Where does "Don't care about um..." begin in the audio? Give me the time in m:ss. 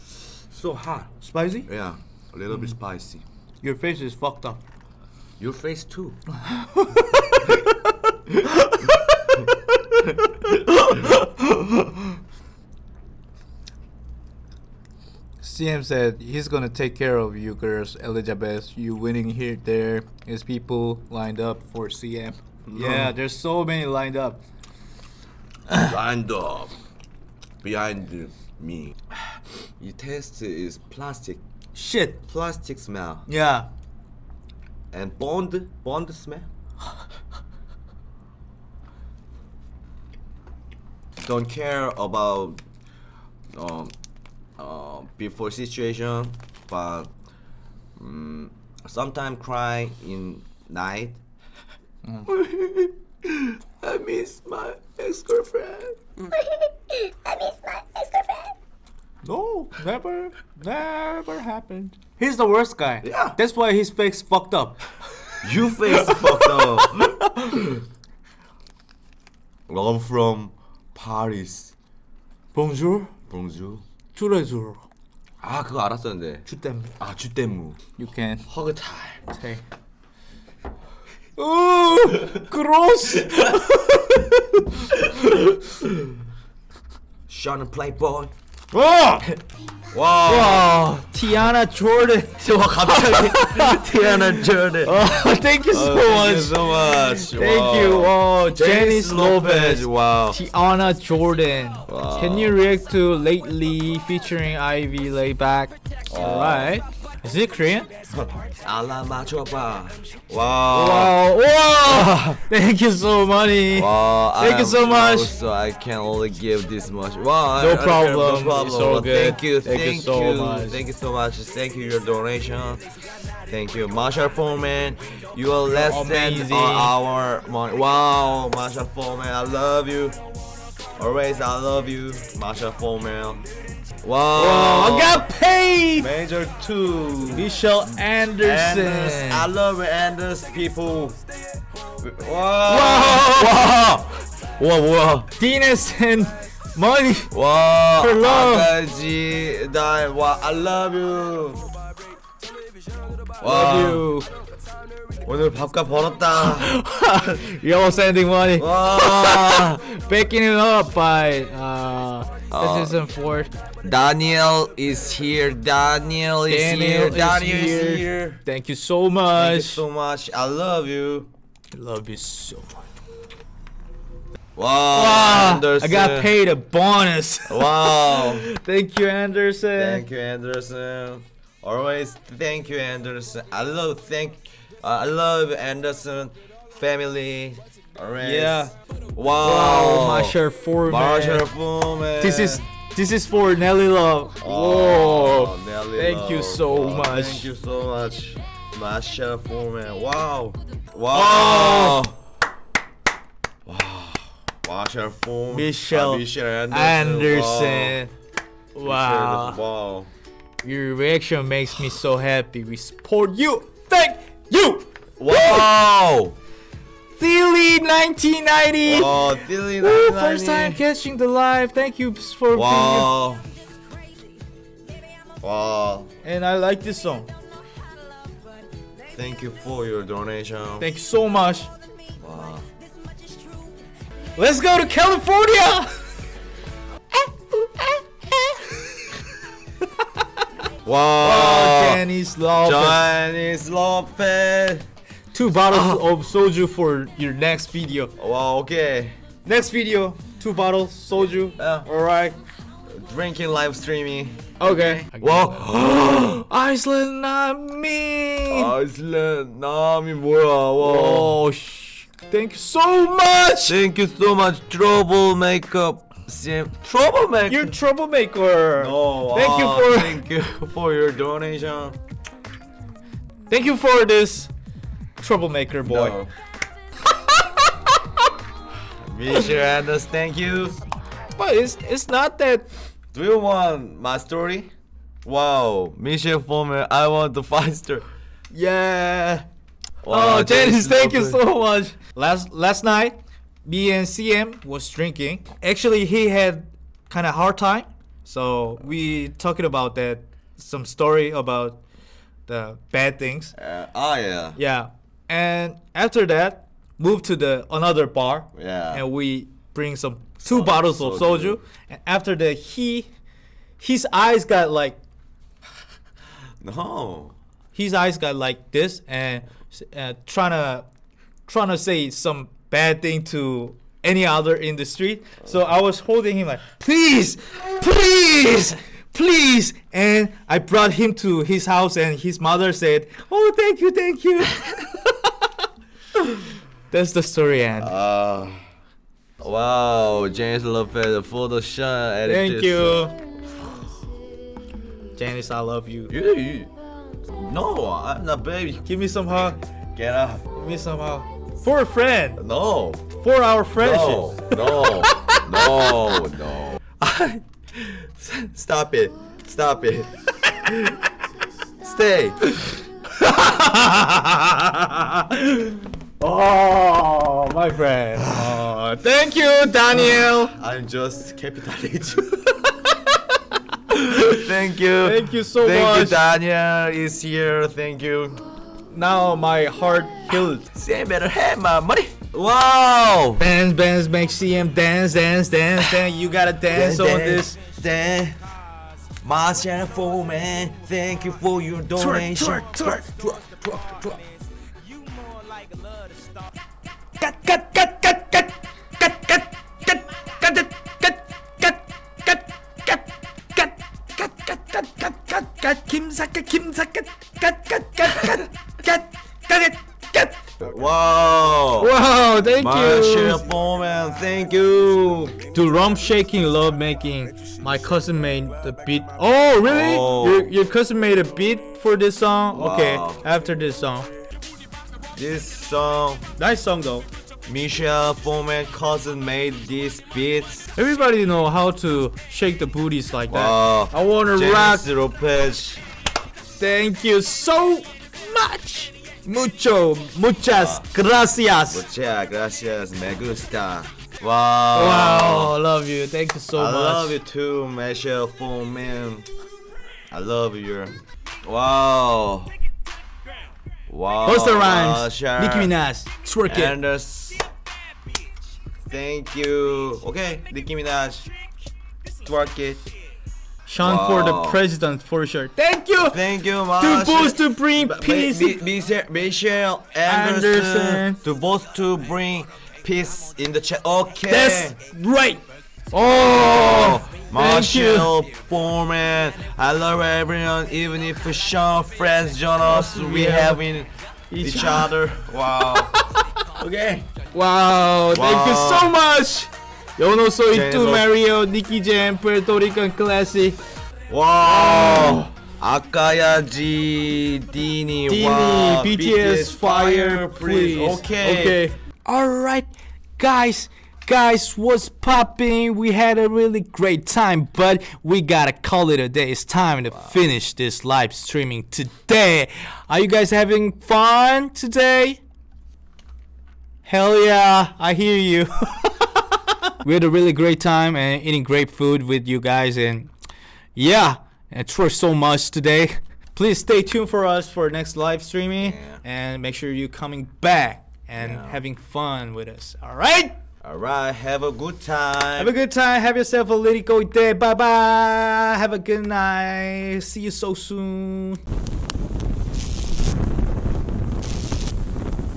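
0:41.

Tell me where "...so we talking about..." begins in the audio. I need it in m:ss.
4:58.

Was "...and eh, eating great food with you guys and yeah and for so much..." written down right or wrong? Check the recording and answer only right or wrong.
right.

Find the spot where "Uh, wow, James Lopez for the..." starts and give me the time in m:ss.
5:37.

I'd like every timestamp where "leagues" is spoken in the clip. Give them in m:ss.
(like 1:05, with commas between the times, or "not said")
not said.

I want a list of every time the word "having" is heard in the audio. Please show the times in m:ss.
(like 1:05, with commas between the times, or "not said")
8:33, 8:51.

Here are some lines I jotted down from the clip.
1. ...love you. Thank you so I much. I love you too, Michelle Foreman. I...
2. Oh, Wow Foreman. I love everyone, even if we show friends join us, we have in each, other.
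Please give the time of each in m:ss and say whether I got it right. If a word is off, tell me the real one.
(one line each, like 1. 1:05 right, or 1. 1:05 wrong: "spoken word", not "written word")
1. 7:25 right
2. 7:55 wrong: "Marshall", not "Wow".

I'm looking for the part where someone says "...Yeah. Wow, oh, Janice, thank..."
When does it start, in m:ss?
4:48.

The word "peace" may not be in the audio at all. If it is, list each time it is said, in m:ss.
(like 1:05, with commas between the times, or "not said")
7:47, 7:52.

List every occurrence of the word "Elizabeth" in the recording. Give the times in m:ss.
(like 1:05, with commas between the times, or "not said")
0:17.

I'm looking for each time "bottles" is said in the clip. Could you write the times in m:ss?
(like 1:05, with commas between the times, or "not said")
4:05, 4:10, 5:10.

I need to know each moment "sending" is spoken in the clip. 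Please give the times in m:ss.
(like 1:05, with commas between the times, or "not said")
2:37.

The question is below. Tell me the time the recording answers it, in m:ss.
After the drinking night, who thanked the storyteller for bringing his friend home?
5:32.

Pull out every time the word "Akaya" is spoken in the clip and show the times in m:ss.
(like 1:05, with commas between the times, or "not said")
8:15.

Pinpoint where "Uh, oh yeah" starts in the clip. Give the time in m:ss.
5:03.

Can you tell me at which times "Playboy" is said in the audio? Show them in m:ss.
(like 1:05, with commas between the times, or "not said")
1:27.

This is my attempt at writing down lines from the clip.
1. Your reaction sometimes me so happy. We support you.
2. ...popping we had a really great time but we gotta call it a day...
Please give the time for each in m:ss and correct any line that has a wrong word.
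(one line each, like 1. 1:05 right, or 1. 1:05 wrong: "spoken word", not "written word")
1. 3:30 wrong: "makes", not "sometimes"
2. 8:24 right.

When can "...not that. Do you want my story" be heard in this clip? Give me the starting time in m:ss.
4:42.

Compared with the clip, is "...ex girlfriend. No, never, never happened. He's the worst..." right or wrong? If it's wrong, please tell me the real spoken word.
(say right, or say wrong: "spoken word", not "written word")
right.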